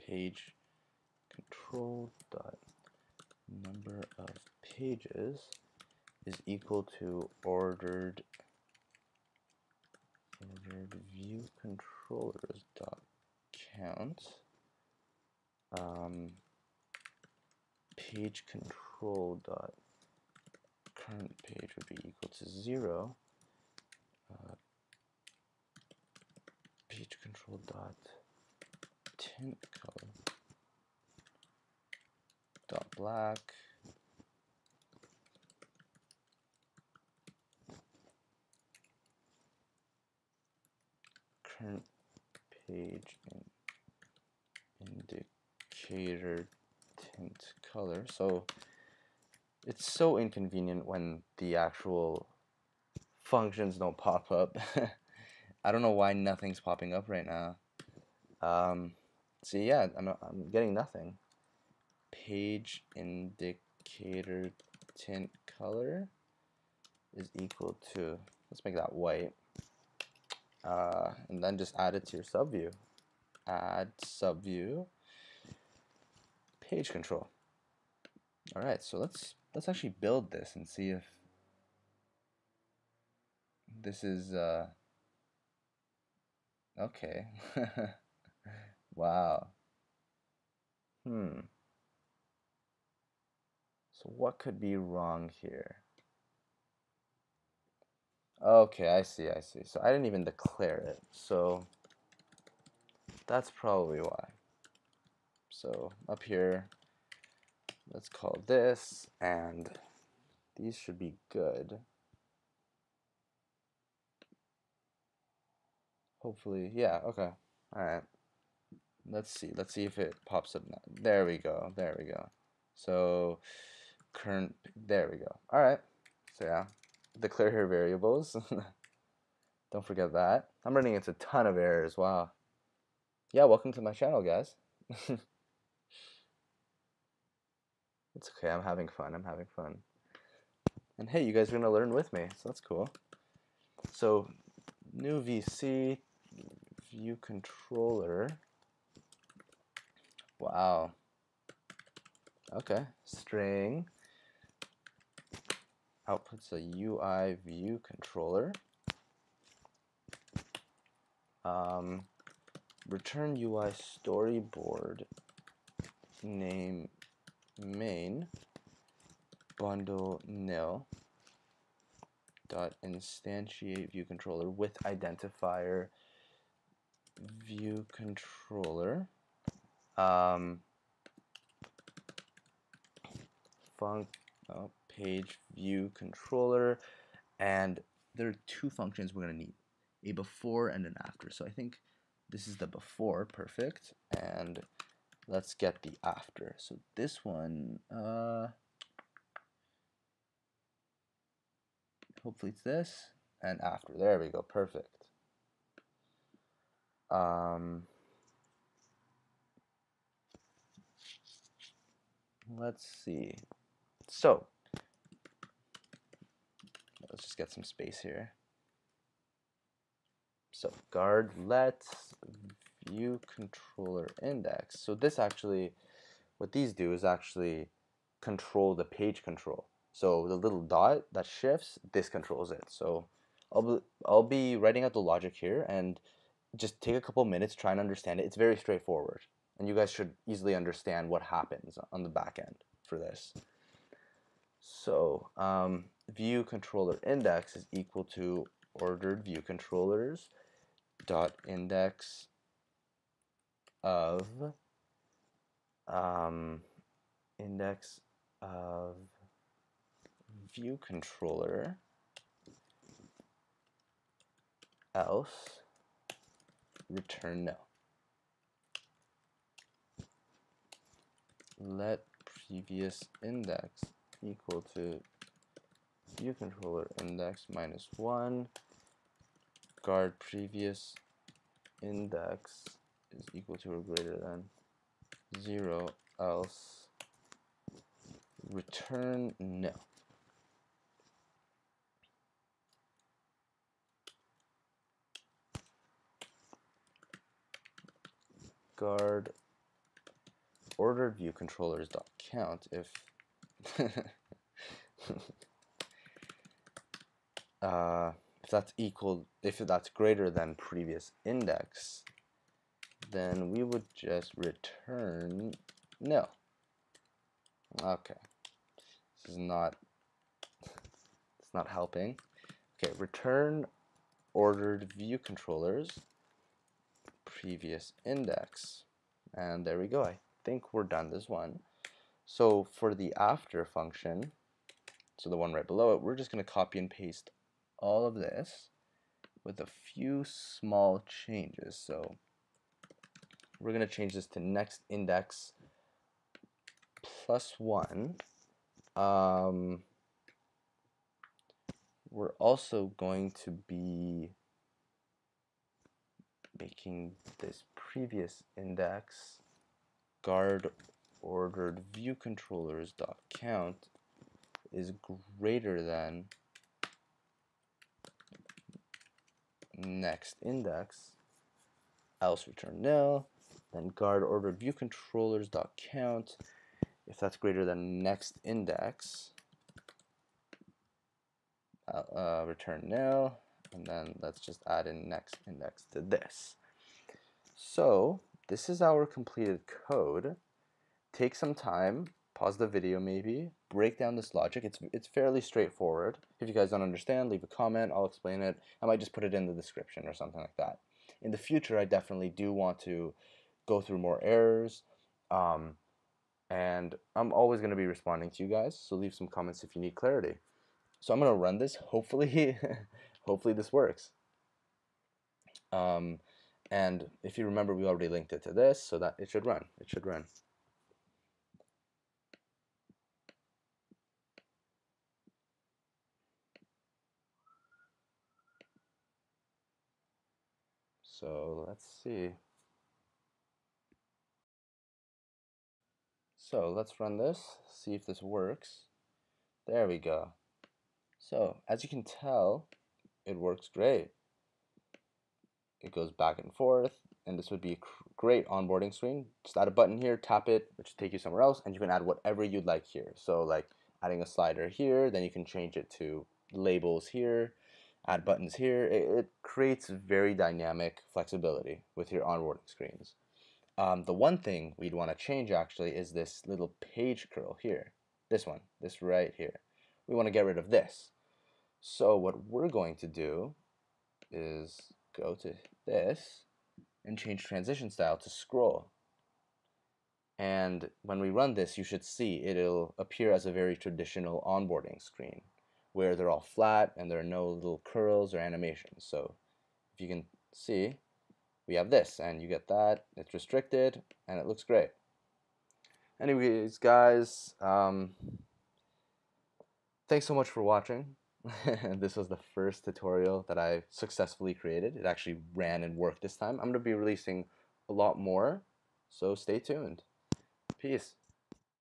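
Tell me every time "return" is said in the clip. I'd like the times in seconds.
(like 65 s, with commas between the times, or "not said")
162 s, 266 s, 288 s, 314 s, 322 s, 372 s, 382 s.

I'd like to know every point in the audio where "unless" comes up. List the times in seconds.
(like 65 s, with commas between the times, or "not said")
not said.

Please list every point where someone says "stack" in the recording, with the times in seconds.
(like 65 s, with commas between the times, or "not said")
not said.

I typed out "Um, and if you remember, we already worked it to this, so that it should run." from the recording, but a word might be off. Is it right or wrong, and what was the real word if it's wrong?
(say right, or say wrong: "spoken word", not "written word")
wrong: "linked", not "worked".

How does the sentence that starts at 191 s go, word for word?
So I think this is the before, perfect, and let's get the after.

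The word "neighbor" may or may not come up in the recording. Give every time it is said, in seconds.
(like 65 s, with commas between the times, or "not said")
not said.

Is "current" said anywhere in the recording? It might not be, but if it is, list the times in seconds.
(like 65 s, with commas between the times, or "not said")
20 s, 124 s.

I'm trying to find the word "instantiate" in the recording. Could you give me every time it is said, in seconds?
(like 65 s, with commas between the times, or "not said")
172 s.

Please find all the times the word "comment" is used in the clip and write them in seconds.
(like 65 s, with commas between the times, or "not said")
397 s, 409 s.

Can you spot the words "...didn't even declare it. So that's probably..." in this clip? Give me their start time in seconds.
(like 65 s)
99 s.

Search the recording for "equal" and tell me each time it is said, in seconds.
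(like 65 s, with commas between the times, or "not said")
6 s, 22 s, 67 s, 247 s, 274 s, 283 s, 308 s.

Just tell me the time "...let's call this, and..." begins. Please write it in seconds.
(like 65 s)
107 s.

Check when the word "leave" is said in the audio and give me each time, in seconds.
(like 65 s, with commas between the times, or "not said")
397 s, 408 s.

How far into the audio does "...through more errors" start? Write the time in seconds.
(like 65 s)
403 s.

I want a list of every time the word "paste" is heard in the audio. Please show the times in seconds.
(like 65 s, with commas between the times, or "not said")
336 s.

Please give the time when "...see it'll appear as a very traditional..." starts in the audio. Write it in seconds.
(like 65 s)
482 s.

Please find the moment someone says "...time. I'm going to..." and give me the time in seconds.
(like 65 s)
506 s.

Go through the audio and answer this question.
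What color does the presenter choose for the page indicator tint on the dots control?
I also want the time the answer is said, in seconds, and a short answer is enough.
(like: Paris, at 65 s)
White, at 68 s.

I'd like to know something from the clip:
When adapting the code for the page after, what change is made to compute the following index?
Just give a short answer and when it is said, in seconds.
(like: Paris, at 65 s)
Plus one, at 347 s.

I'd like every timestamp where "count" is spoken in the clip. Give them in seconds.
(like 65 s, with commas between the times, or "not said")
13 s, 302 s, 363 s, 375 s.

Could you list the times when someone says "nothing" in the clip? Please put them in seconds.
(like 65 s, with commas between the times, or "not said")
56 s, 60 s.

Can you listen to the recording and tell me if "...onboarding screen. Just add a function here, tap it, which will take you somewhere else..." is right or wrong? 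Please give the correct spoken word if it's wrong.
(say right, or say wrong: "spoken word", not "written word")
wrong: "button", not "function".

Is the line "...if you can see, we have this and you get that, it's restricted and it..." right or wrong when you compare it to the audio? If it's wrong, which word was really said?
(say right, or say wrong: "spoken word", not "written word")
right.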